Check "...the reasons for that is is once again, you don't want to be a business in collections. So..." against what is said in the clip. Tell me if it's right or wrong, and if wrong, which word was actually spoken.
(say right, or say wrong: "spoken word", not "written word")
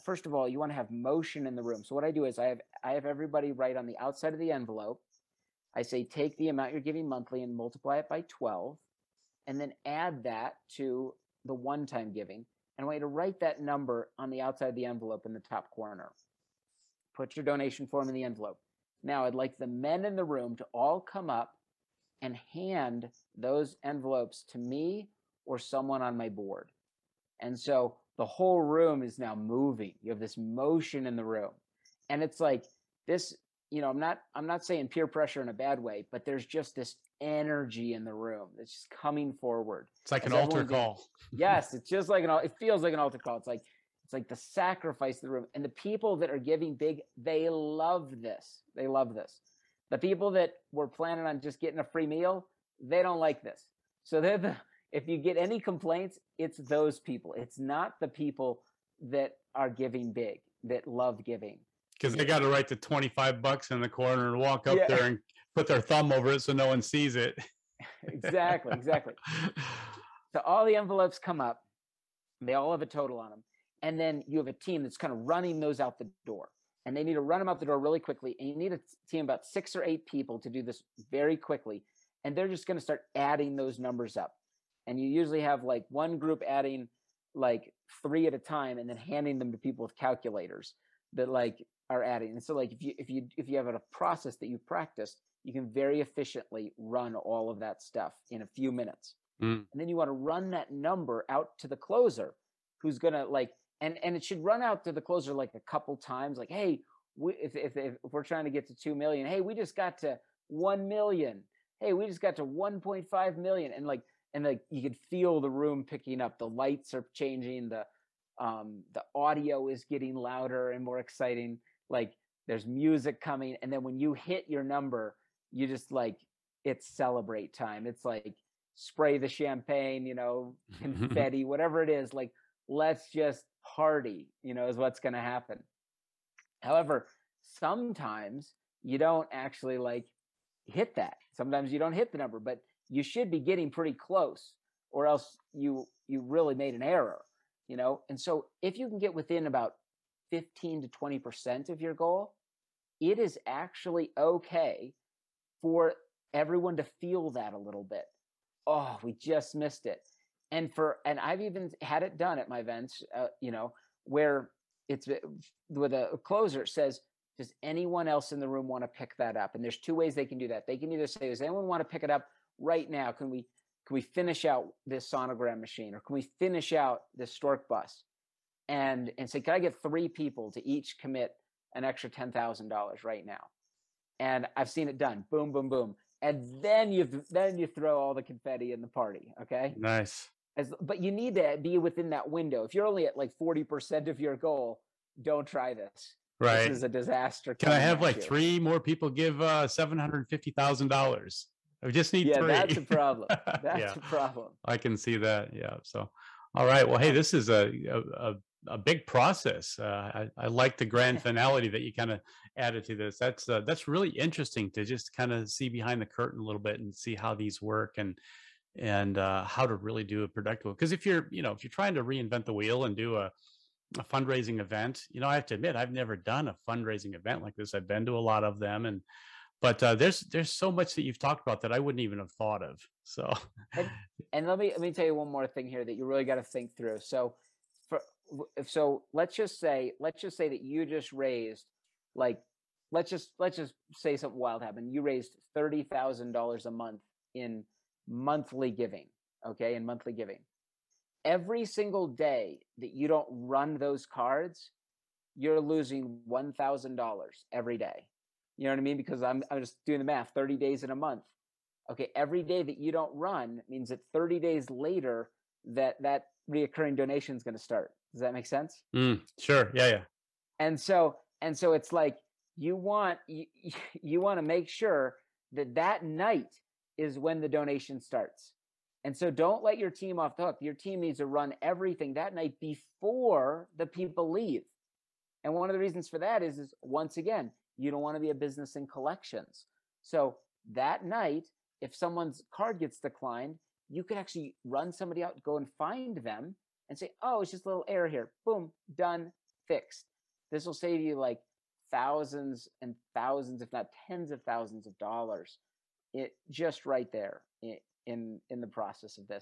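right.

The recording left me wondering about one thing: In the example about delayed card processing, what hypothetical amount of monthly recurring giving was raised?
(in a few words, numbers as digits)
$30,000.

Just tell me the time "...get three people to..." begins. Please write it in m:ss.
2:59.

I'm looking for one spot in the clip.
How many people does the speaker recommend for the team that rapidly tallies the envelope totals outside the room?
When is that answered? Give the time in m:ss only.
1:19.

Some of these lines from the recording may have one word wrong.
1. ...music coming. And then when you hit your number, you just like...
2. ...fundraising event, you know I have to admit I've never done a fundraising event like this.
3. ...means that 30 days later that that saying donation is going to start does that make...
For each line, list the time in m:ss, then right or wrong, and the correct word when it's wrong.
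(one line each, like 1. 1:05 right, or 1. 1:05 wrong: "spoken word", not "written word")
1. 2:02 right
2. 3:44 right
3. 4:23 wrong: "reoccurring", not "saying".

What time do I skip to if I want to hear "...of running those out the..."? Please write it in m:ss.
1:15.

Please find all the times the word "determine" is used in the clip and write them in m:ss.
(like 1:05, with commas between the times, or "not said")
not said.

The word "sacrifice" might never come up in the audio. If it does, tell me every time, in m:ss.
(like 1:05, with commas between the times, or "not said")
0:44.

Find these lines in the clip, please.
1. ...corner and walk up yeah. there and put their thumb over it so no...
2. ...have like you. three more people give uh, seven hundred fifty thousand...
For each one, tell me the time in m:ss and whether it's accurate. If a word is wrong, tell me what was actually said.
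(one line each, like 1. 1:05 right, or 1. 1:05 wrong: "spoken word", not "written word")
1. 1:03 right
2. 3:17 right.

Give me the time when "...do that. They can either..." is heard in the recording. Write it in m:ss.
2:50.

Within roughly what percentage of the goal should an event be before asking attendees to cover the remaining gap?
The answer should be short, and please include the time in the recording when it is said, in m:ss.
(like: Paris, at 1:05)
15 to 20%, at 2:30.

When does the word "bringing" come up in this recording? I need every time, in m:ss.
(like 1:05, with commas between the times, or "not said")
not said.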